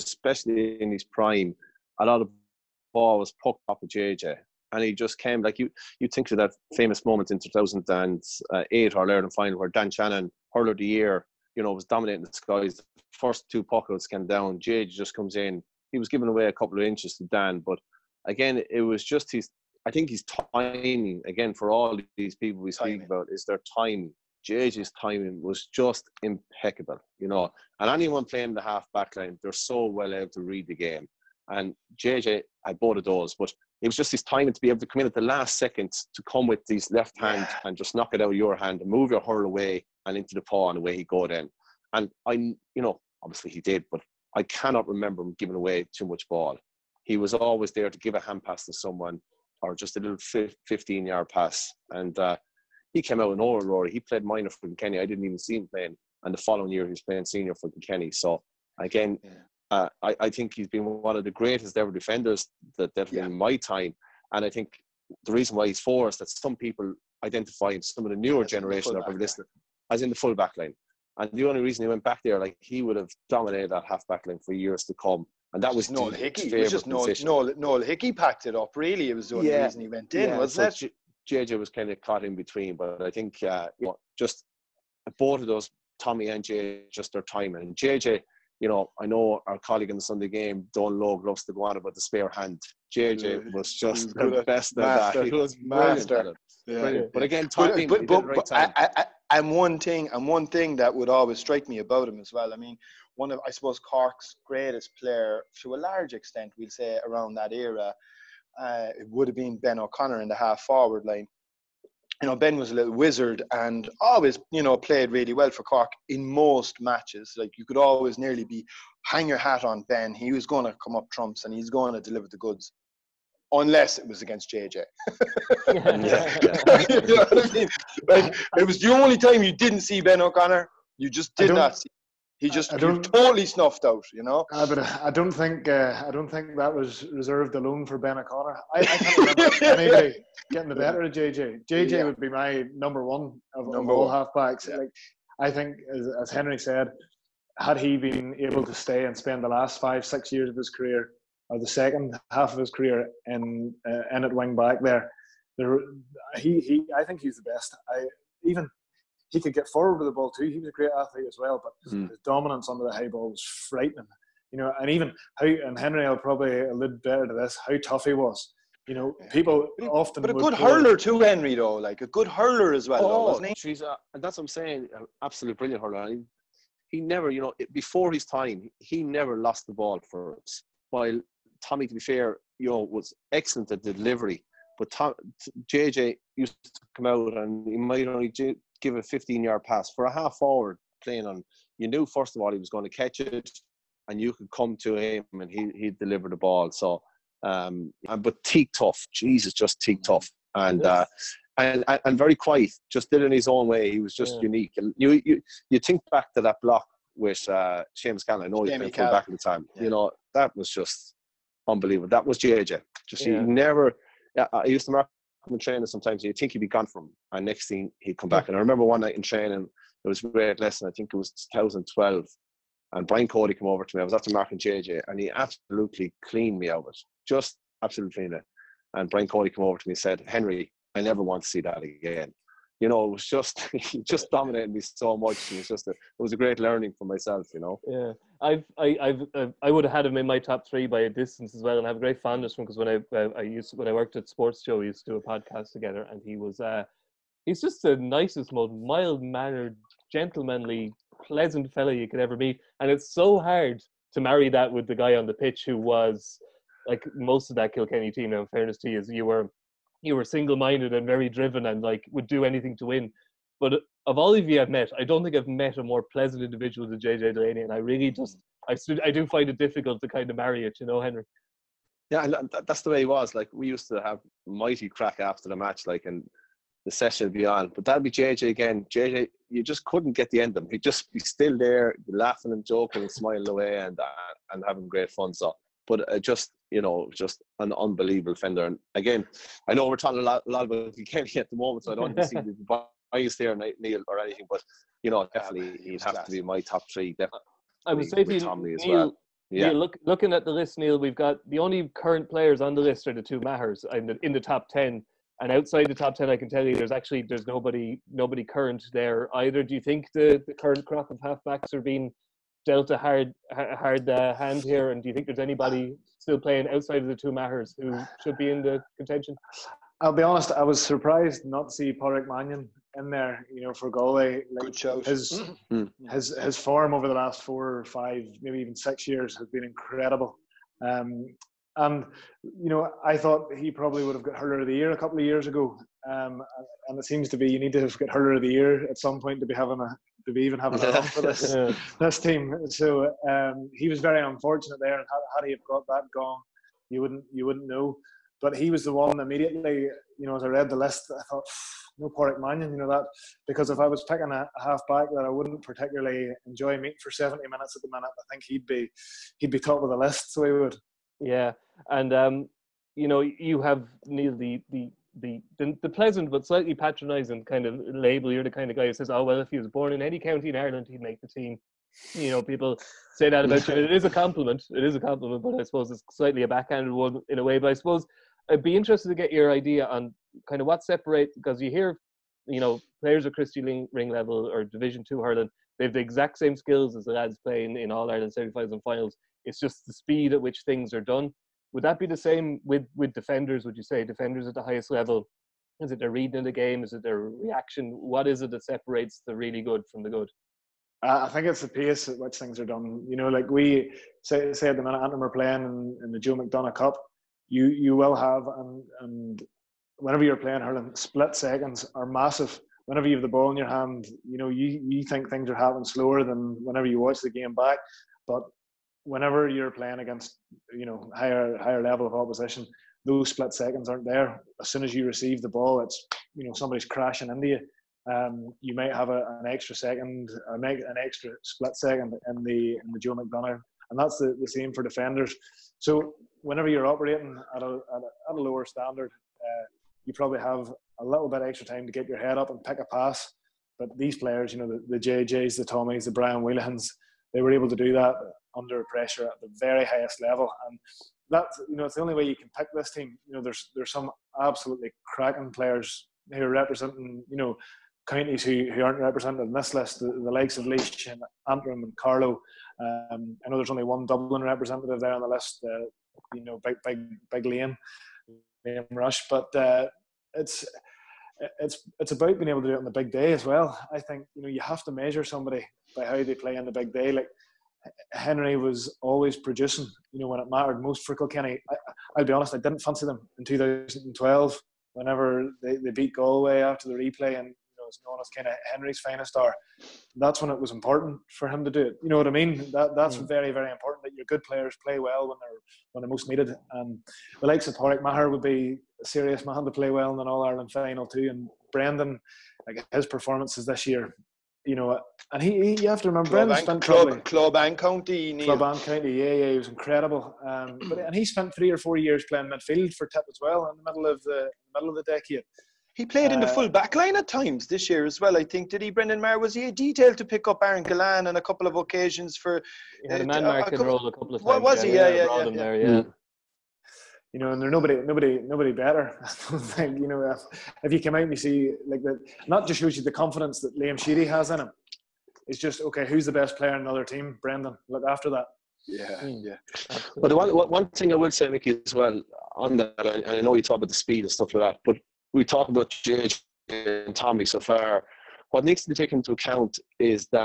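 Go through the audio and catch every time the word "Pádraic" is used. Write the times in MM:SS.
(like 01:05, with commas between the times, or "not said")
05:21, 05:52.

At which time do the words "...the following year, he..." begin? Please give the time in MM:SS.
00:56.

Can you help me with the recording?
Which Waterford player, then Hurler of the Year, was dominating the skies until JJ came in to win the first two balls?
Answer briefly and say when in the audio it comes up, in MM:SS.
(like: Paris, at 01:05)
Dan Shanahan, at 00:09.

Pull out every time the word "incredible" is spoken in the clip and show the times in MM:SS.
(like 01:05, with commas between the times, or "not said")
05:29, 08:29.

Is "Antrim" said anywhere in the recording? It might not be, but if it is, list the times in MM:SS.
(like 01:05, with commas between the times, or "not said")
06:45, 07:41.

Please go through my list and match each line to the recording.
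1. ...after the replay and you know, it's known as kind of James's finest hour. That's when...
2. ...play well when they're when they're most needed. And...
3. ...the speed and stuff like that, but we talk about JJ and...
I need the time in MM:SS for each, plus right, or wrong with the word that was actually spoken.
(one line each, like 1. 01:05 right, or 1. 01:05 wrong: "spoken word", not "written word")
1. 08:06 wrong: "Henry", not "James"
2. 08:14 right
3. 09:03 right.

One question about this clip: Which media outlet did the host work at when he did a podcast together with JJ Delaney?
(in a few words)
SportsJOE.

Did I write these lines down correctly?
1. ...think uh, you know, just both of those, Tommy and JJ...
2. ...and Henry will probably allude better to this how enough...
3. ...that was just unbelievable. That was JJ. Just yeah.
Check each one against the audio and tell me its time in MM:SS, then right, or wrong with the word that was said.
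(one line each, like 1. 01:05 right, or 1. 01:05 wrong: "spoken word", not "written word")
1. 01:23 right
2. 02:45 wrong: "tough", not "enough"
3. 03:30 right.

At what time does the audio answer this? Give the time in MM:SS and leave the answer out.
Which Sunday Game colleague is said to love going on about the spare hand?
01:30.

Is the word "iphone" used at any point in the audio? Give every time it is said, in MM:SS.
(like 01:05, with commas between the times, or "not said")
not said.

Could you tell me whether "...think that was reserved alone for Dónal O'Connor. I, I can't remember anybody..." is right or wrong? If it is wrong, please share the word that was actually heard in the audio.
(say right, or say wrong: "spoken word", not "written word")
wrong: "Ben", not "Dónal".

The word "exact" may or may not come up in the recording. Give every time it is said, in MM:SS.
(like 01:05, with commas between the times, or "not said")
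06:25.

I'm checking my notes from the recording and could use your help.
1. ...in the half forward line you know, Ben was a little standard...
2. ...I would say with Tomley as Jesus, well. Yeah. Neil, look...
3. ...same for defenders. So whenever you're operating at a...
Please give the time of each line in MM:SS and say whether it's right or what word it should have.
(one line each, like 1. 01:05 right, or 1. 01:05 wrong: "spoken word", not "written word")
1. 01:50 wrong: "wizard", not "standard"
2. 04:57 wrong: "Neil", not "Jesus"
3. 07:14 right.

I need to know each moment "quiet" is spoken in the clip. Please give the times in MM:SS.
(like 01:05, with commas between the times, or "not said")
03:22.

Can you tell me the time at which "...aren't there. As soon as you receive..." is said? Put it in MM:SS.
07:03.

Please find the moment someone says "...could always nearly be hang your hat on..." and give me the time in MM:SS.
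01:57.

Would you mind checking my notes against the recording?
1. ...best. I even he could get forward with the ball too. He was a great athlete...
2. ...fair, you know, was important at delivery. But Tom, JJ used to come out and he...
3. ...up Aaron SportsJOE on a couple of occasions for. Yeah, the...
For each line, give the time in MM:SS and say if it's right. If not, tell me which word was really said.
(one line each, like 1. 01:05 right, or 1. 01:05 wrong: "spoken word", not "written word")
1. 02:37 right
2. 03:01 wrong: "excellent", not "important"
3. 08:40 wrong: "Gillane", not "SportsJOE".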